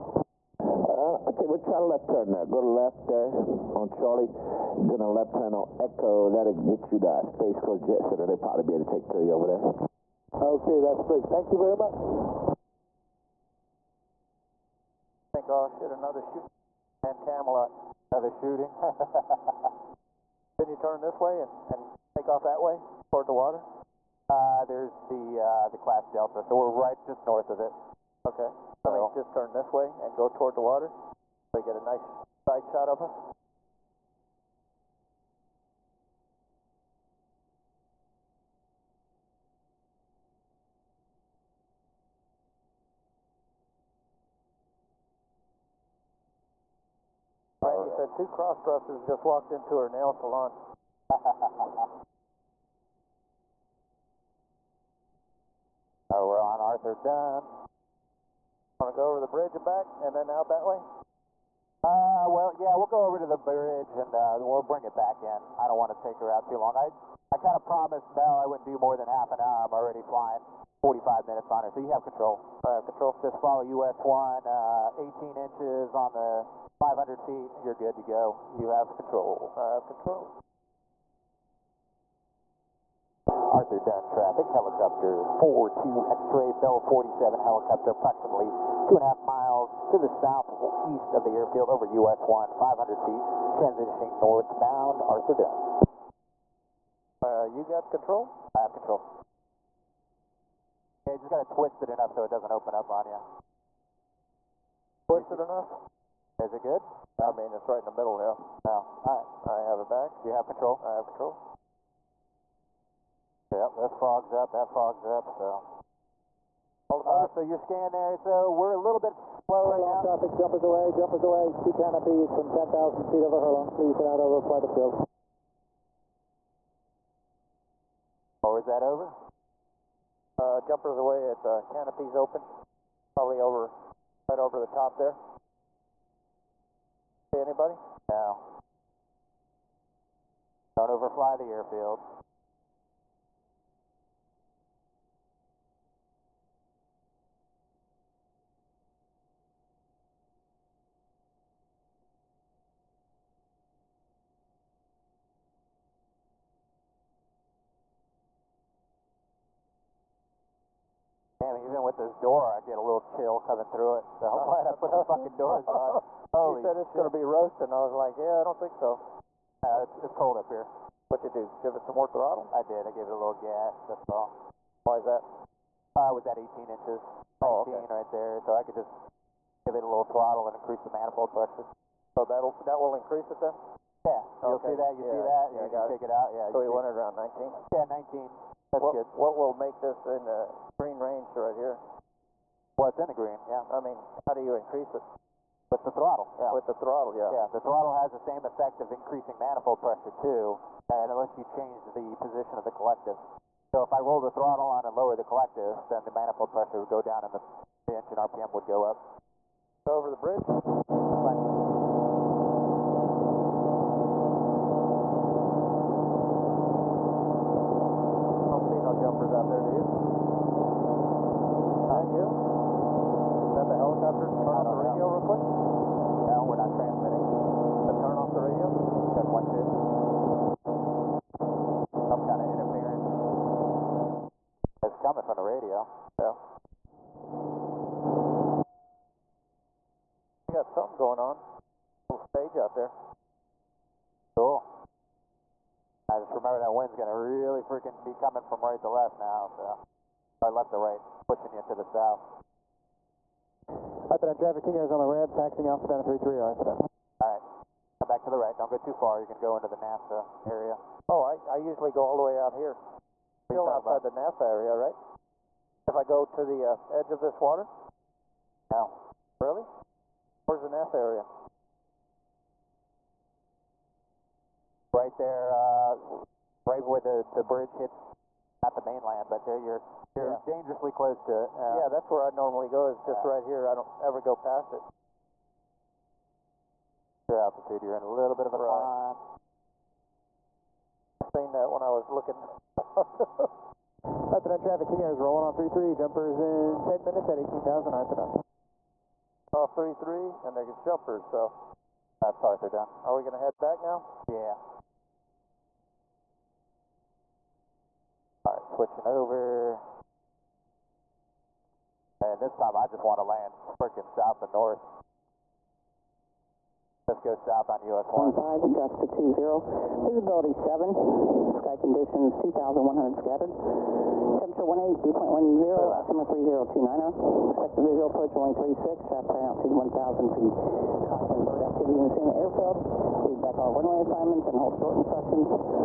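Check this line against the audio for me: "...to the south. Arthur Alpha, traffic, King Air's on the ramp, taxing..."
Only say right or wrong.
wrong.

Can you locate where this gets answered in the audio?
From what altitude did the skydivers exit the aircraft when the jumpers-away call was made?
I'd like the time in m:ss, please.
2:02.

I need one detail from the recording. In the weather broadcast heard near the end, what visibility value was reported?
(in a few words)
7.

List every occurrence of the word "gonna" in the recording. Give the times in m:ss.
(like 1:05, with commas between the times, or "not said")
2:47, 4:06.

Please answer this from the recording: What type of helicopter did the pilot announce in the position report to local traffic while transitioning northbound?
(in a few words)
Bell 47.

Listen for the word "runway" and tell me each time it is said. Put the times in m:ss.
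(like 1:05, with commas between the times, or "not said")
5:28, 5:33.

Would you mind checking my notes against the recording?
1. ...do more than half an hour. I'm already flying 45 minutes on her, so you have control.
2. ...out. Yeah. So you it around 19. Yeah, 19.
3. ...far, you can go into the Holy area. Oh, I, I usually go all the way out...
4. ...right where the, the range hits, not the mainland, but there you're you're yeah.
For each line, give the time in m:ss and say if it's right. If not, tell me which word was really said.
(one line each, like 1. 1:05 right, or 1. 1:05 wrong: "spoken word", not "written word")
1. 1:08 right
2. 3:06 right
3. 4:18 wrong: "NASA", not "Holy"
4. 4:36 wrong: "bridge", not "range".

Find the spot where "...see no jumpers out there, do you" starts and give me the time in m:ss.
3:38.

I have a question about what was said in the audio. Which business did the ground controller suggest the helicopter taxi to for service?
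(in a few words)
Space Coast Jet Center.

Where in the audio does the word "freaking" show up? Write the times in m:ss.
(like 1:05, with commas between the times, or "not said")
4:07, 5:13.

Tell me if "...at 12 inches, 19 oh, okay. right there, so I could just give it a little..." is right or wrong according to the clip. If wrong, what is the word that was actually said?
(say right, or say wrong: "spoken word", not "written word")
wrong: "18", not "12".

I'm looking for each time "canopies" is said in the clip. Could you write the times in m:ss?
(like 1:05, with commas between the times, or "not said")
2:01, 2:11.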